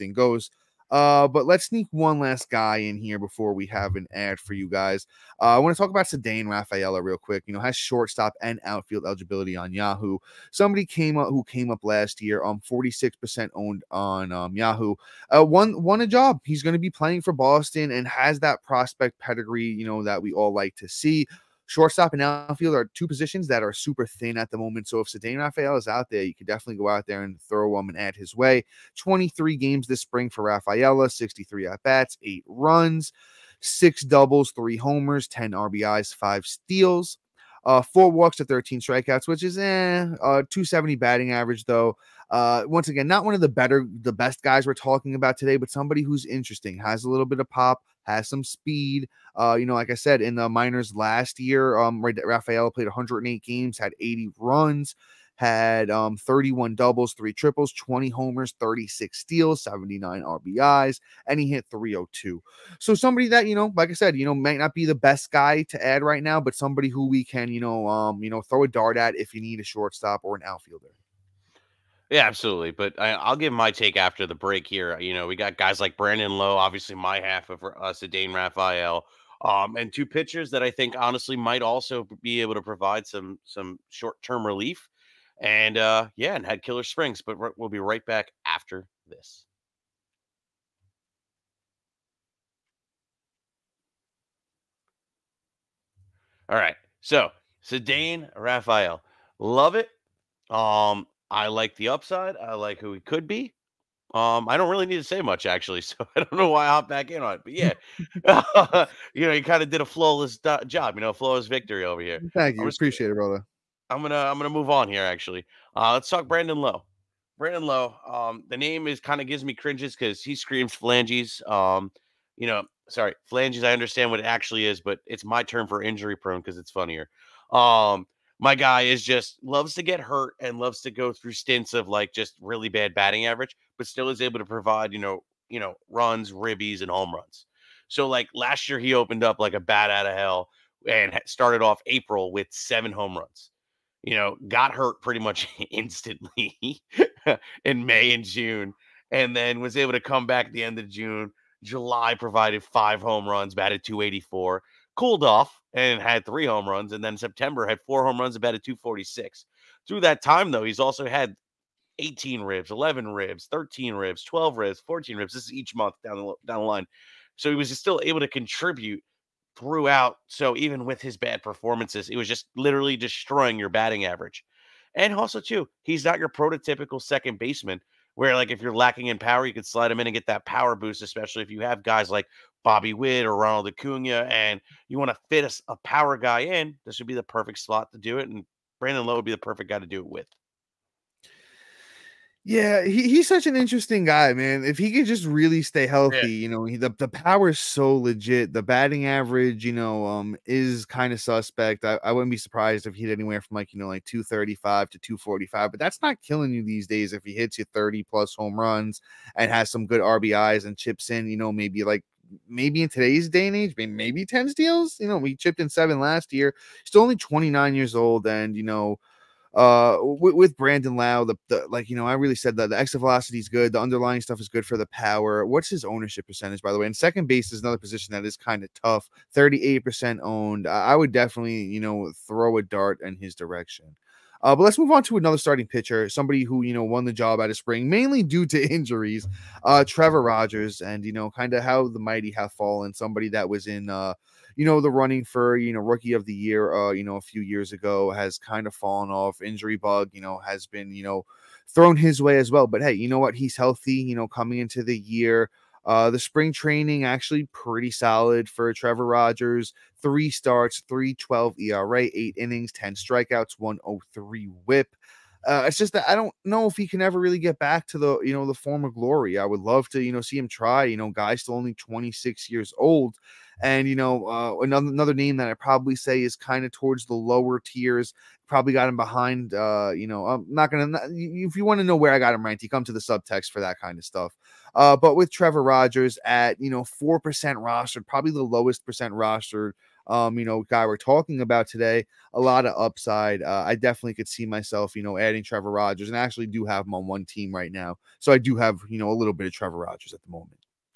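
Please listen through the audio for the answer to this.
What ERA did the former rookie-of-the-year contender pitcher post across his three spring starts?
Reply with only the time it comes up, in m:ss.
4:20.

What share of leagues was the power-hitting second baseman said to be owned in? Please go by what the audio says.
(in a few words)
38%.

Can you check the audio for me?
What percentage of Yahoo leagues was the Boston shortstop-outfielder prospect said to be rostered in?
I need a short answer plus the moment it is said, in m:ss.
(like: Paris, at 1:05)
46%, at 0:12.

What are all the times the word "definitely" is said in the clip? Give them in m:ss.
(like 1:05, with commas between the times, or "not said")
0:26, 3:51, 4:53.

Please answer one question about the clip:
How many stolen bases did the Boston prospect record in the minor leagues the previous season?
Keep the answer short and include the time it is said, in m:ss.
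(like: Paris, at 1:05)
36, at 0:58.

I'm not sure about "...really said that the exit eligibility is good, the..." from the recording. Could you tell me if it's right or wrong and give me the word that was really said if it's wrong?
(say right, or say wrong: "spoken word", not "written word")
wrong: "velocity", not "eligibility".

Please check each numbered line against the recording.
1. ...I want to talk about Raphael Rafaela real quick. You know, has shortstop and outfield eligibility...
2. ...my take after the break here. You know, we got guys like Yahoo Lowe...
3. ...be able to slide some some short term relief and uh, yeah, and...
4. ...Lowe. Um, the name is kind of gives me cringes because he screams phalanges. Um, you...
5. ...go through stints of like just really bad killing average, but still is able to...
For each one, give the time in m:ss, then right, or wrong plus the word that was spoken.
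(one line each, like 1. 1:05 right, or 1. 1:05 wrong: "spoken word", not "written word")
1. 0:05 wrong: "Ceddanne", not "Raphael"
2. 1:13 wrong: "Brandon", not "Yahoo"
3. 1:22 wrong: "provide", not "slide"
4. 1:57 right
5. 2:10 wrong: "batting", not "killing".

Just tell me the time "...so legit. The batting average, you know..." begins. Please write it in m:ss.
3:17.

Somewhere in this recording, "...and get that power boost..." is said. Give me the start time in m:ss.
3:00.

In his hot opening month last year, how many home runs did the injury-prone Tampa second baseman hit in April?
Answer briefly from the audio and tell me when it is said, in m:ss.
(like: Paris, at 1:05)
7, at 2:22.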